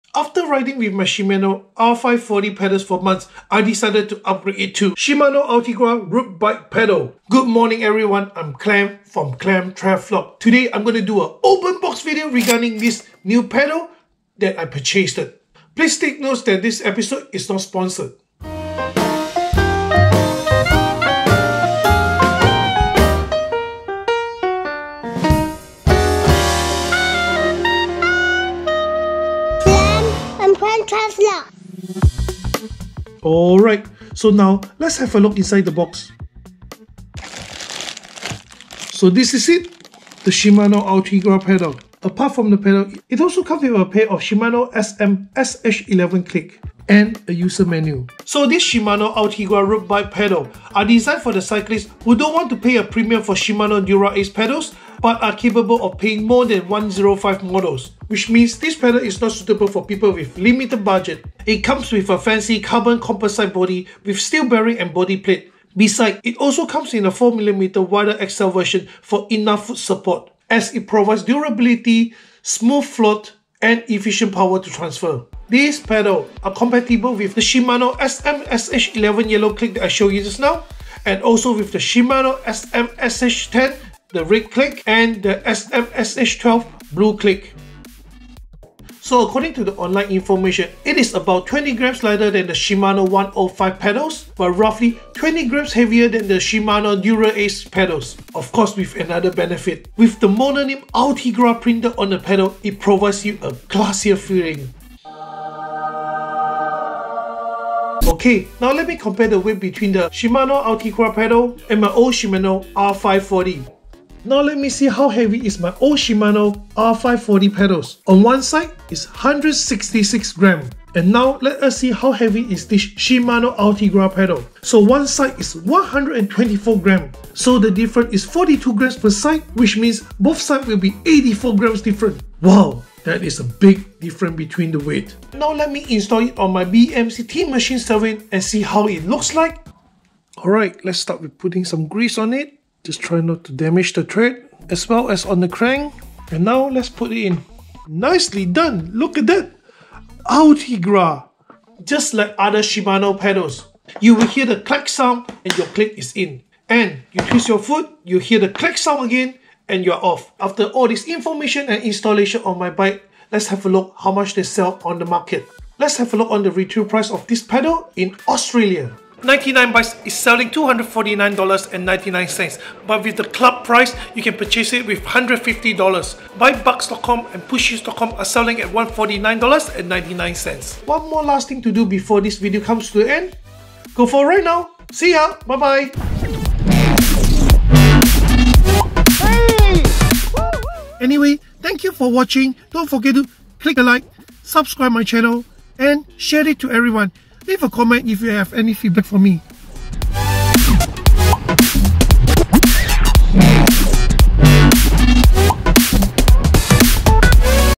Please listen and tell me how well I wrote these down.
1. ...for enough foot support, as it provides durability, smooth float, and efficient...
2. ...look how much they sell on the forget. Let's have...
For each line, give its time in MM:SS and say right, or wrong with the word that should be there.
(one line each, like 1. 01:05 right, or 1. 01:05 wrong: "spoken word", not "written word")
1. 01:09 right
2. 02:43 wrong: "market", not "forget".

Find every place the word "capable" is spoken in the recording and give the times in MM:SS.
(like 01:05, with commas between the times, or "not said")
00:55.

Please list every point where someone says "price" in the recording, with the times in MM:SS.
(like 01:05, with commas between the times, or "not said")
02:46, 02:53.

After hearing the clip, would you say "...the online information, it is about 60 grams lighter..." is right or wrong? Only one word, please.
wrong.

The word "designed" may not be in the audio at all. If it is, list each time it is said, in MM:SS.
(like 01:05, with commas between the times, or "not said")
00:50.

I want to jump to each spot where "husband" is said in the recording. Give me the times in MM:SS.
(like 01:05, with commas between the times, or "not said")
not said.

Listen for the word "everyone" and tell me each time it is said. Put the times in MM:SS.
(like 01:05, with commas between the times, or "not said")
00:07, 03:16.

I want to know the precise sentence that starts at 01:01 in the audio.
It comes with a fancy carbon composite body with steel bearing and body plate.